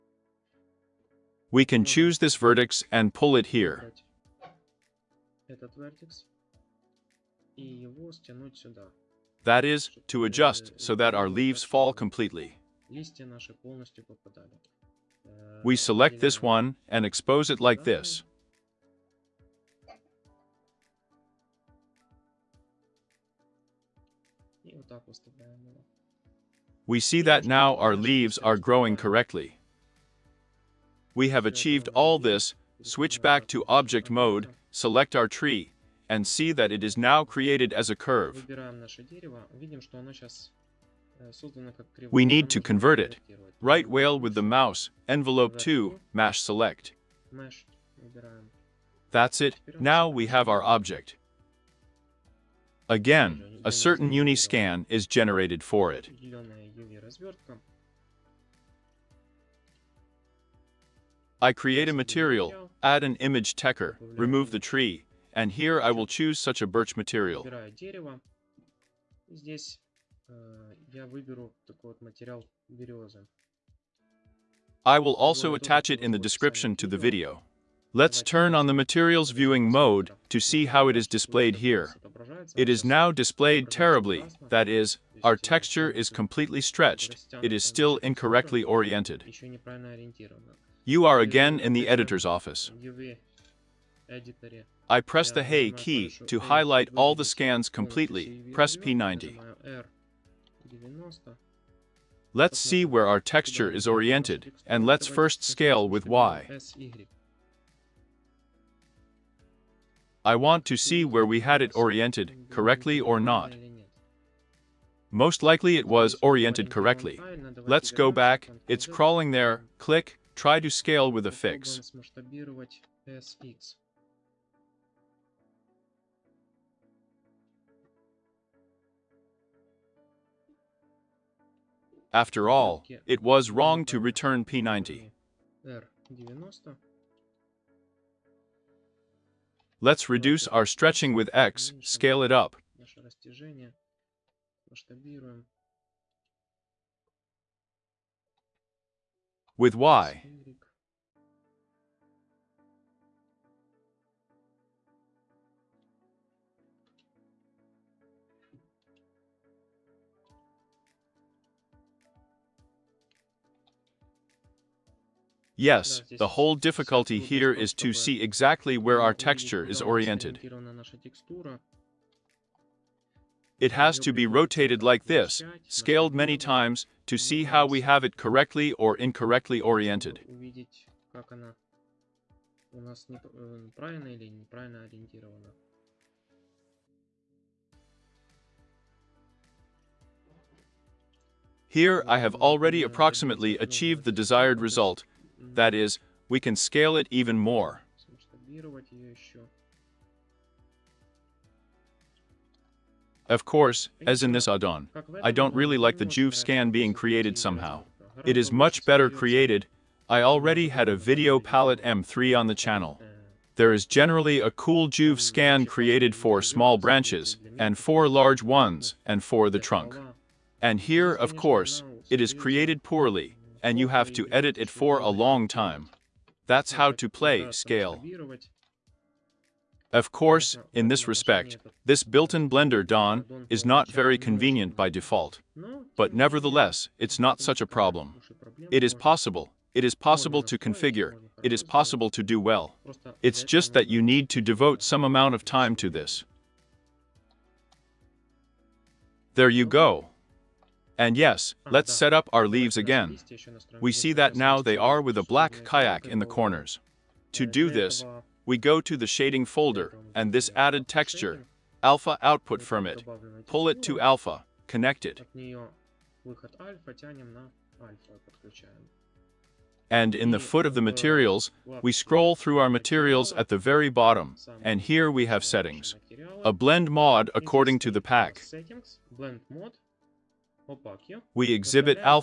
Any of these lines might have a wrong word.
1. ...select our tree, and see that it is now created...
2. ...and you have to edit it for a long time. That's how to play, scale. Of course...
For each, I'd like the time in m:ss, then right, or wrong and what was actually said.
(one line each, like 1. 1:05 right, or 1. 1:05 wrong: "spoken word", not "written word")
1. 0:34 right
2. 3:43 right.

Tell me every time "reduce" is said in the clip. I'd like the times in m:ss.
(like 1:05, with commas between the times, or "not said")
2:20.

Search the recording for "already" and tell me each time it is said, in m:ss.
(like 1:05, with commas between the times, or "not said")
3:12, 3:30.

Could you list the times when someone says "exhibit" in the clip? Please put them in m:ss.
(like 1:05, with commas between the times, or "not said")
4:41.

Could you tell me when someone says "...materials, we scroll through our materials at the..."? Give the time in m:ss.
4:30.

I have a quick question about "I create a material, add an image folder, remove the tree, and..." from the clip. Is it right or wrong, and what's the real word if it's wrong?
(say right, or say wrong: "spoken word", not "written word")
wrong: "techer", not "folder".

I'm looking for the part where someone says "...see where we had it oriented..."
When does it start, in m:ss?
1:50.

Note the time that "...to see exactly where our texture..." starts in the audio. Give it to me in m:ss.
2:47.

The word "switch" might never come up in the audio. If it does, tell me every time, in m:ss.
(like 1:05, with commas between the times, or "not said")
0:32.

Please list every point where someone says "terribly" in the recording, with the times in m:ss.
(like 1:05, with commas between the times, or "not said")
1:23.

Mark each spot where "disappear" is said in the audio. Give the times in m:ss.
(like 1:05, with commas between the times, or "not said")
not said.